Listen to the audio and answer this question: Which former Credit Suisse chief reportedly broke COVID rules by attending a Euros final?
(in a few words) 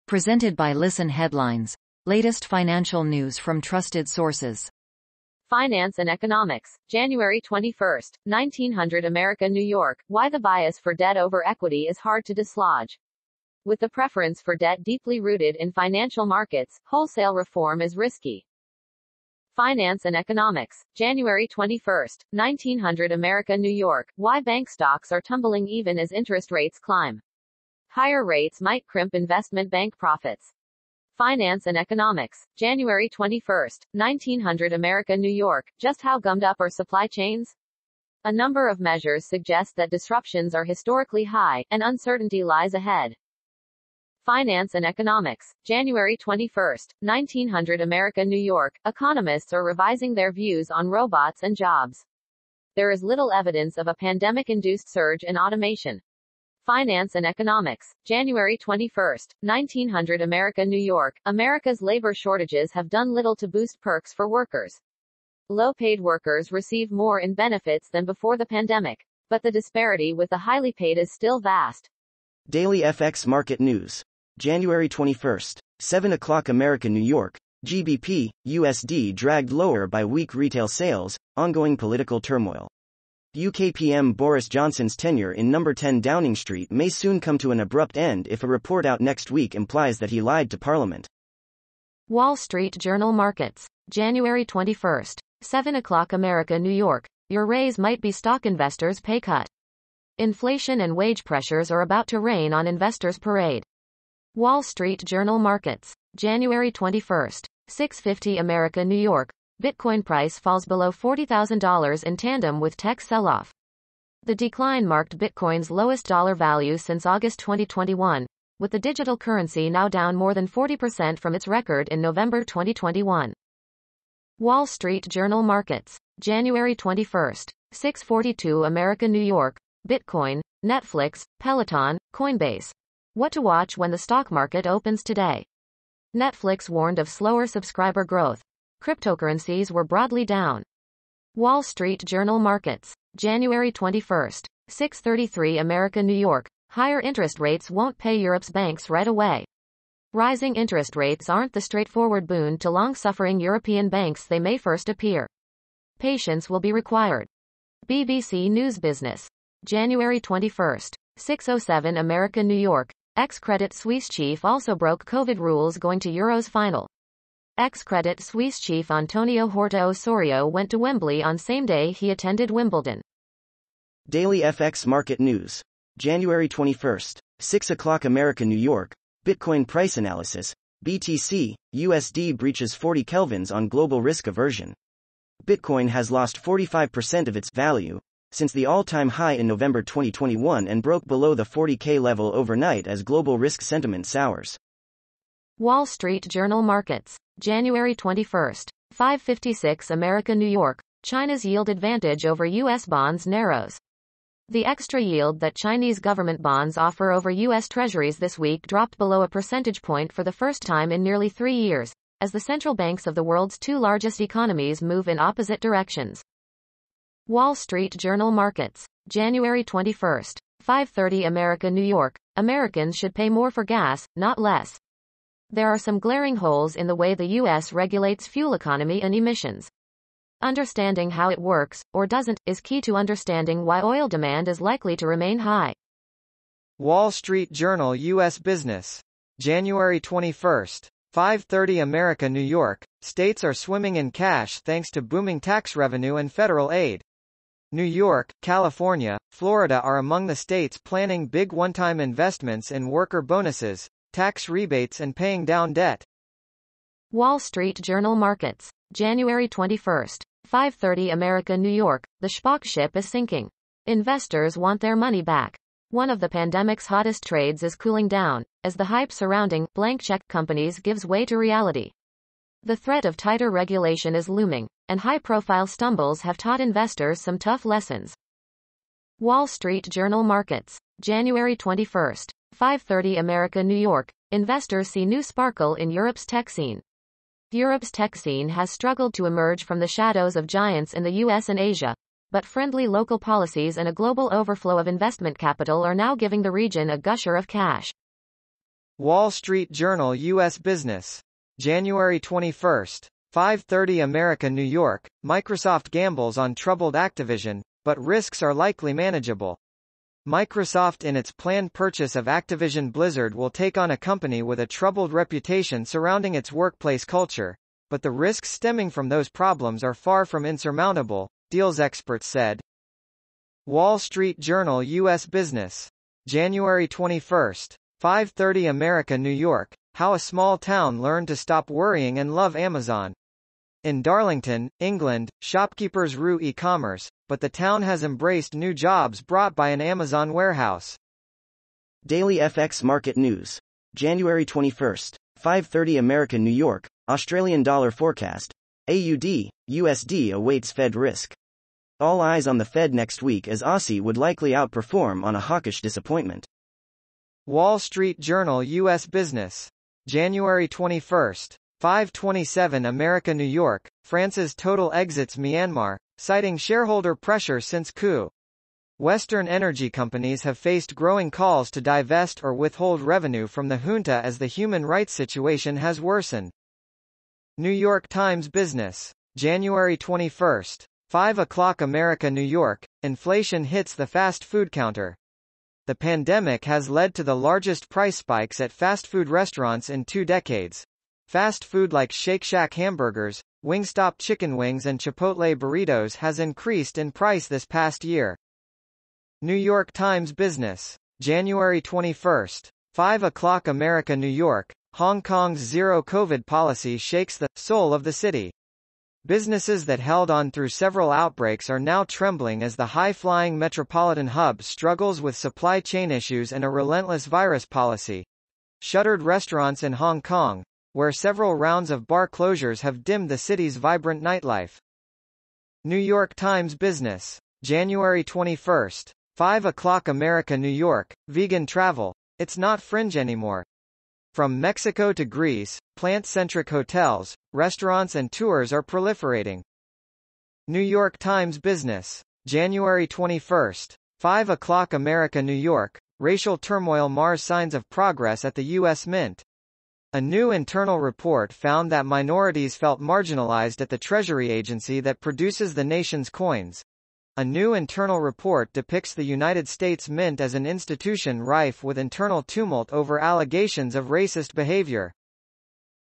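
Antonio Horta Osorio.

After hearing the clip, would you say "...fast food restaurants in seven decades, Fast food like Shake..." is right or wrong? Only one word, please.
wrong.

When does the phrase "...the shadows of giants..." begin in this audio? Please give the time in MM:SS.
04:49.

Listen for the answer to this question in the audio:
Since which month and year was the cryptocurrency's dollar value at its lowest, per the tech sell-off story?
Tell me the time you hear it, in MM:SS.
01:57.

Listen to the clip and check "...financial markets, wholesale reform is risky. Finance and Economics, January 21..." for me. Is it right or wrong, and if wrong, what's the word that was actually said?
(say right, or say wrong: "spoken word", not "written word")
right.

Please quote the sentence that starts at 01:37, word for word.
Your raise might be stock investors' pay cut.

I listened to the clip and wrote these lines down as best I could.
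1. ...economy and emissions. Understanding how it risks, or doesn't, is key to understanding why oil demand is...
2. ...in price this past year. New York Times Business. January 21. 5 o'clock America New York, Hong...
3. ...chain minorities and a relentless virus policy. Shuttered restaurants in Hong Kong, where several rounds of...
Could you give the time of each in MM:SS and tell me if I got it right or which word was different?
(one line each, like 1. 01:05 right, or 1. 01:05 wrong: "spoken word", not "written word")
1. 03:48 wrong: "works", not "risks"
2. 06:36 right
3. 06:55 wrong: "issues", not "minorities".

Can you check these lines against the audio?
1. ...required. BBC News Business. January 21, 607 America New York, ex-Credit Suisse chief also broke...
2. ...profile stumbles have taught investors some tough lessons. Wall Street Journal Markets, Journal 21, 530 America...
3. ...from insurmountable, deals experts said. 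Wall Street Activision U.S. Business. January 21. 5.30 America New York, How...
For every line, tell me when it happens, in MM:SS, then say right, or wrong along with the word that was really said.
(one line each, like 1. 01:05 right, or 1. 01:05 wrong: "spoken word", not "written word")
1. 02:36 right
2. 04:35 wrong: "January", not "Journal"
3. 05:20 wrong: "Journal", not "Activision".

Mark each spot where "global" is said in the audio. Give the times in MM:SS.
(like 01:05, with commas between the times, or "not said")
03:03, 03:13, 04:53.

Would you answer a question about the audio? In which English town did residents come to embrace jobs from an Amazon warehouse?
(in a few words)
Darlington.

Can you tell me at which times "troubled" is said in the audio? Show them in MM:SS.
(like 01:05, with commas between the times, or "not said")
05:06, 05:14.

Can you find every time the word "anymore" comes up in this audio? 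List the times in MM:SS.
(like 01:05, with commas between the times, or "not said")
07:13.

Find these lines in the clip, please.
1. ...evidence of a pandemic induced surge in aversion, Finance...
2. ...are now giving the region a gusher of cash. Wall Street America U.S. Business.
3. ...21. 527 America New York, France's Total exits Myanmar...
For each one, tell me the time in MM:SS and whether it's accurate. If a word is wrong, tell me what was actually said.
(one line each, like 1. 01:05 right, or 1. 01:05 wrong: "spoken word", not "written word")
1. 00:53 wrong: "automation", not "aversion"
2. 04:55 wrong: "Journal", not "America"
3. 06:00 right.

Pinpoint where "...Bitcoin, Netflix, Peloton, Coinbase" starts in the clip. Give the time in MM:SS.
02:09.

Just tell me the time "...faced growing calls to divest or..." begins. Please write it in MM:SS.
06:10.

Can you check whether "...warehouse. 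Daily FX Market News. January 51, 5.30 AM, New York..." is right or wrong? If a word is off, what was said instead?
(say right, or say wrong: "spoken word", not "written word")
wrong: "21", not "51".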